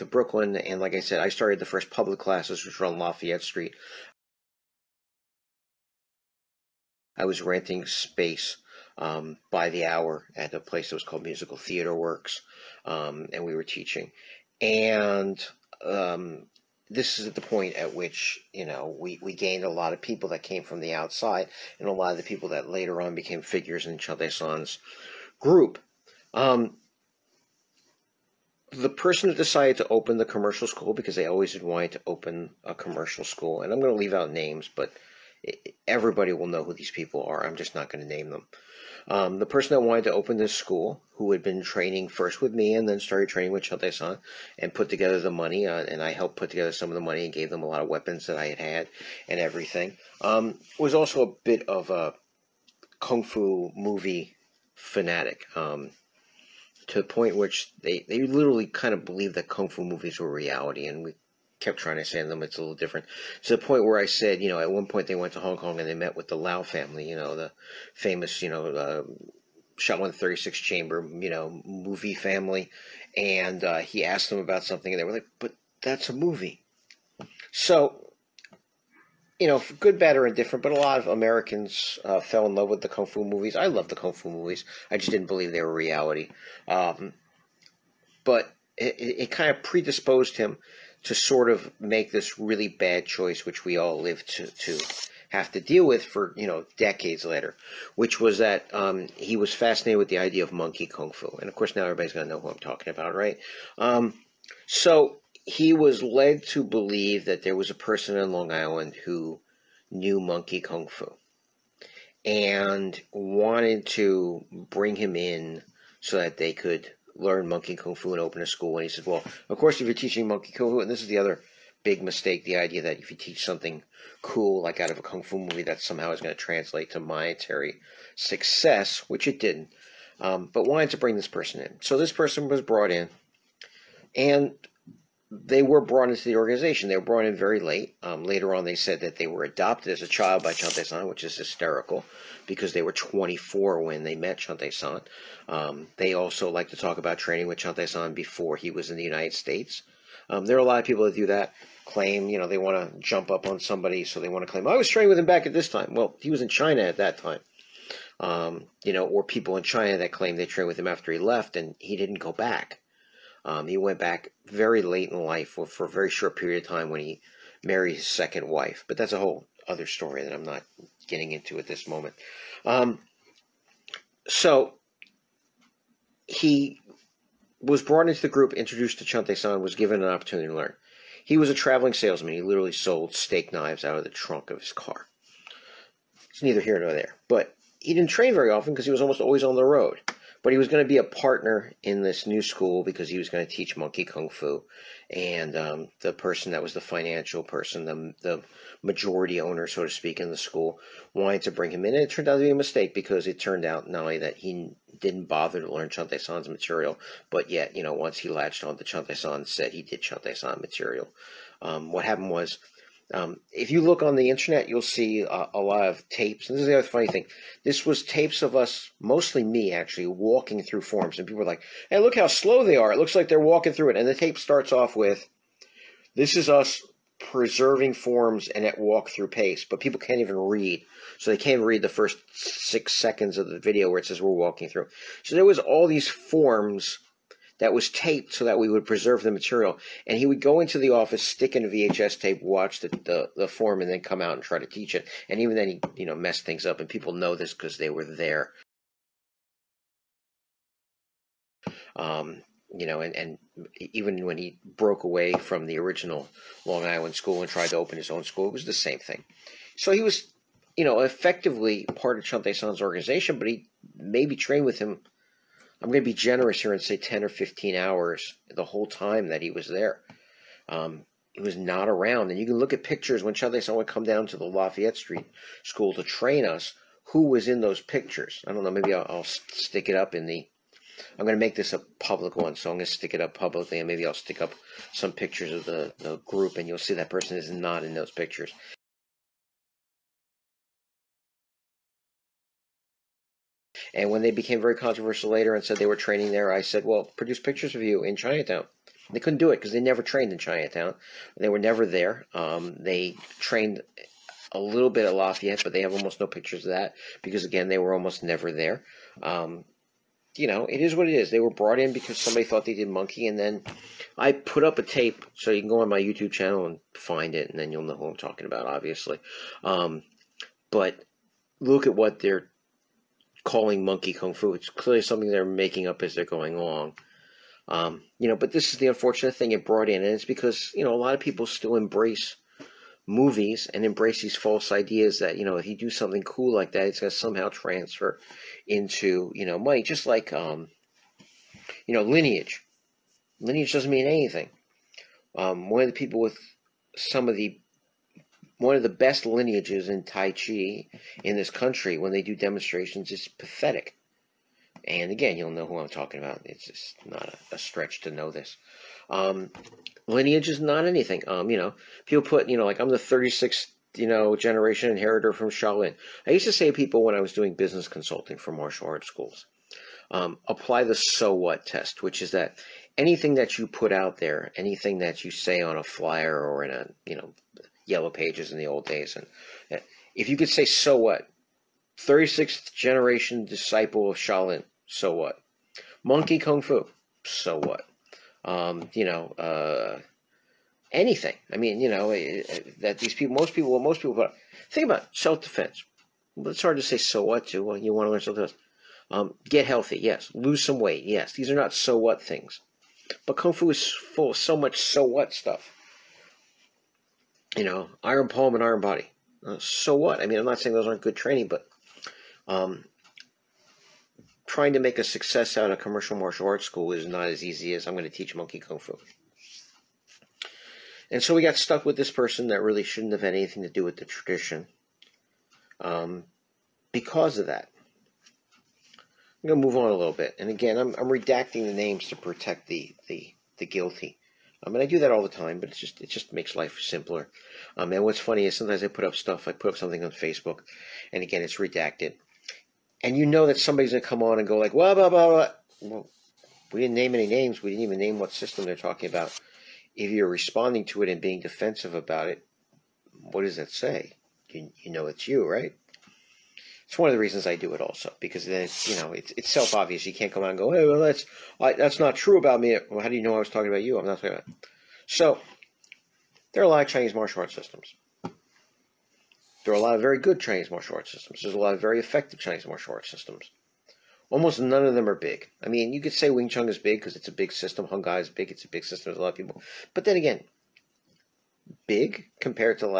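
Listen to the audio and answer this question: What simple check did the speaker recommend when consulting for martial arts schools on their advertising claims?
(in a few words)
The so what test.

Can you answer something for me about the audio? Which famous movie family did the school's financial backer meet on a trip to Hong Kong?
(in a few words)
the Lau family.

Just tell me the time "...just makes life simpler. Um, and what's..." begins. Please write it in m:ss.
7:16.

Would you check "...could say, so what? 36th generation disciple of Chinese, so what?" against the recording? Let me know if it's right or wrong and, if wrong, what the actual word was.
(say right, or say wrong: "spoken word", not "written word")
wrong: "Shaolin", not "Chinese".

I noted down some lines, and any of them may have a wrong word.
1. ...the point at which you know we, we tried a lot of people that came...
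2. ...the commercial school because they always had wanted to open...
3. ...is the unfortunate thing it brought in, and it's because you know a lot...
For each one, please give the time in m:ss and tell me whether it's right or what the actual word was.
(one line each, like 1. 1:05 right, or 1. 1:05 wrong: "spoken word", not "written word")
1. 0:17 wrong: "gained", not "tried"
2. 0:30 right
3. 5:28 right.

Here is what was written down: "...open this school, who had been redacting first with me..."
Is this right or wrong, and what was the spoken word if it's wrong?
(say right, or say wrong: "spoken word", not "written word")
wrong: "training", not "redacting".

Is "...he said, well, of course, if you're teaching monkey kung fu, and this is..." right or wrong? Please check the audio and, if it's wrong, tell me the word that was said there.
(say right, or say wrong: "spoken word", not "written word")
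right.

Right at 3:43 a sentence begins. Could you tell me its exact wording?
And the tape starts off with, this is us preserving forms and at walk through pace.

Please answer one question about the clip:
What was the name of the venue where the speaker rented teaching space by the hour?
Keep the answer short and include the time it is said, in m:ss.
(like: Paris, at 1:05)
Musical Theater Works, at 0:11.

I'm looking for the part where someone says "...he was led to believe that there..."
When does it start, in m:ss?
1:45.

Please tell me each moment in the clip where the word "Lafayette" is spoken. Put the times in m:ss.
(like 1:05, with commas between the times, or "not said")
0:02, 4:34, 5:05.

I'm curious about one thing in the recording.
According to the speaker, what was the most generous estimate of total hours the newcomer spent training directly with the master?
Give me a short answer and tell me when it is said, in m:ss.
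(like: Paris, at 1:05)
10 or 15 hours, at 4:26.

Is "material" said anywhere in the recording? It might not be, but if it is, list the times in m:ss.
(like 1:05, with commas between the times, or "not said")
3:26, 3:30, 3:59.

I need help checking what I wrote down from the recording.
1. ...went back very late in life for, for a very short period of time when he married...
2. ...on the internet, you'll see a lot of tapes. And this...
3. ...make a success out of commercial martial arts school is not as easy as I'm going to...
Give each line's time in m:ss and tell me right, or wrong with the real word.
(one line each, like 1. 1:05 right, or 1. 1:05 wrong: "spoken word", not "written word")
1. 2:43 right
2. 3:34 right
3. 6:54 right.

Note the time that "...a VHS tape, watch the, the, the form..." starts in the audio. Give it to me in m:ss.
4:01.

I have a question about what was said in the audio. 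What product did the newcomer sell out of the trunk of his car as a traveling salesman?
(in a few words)
Steak knives.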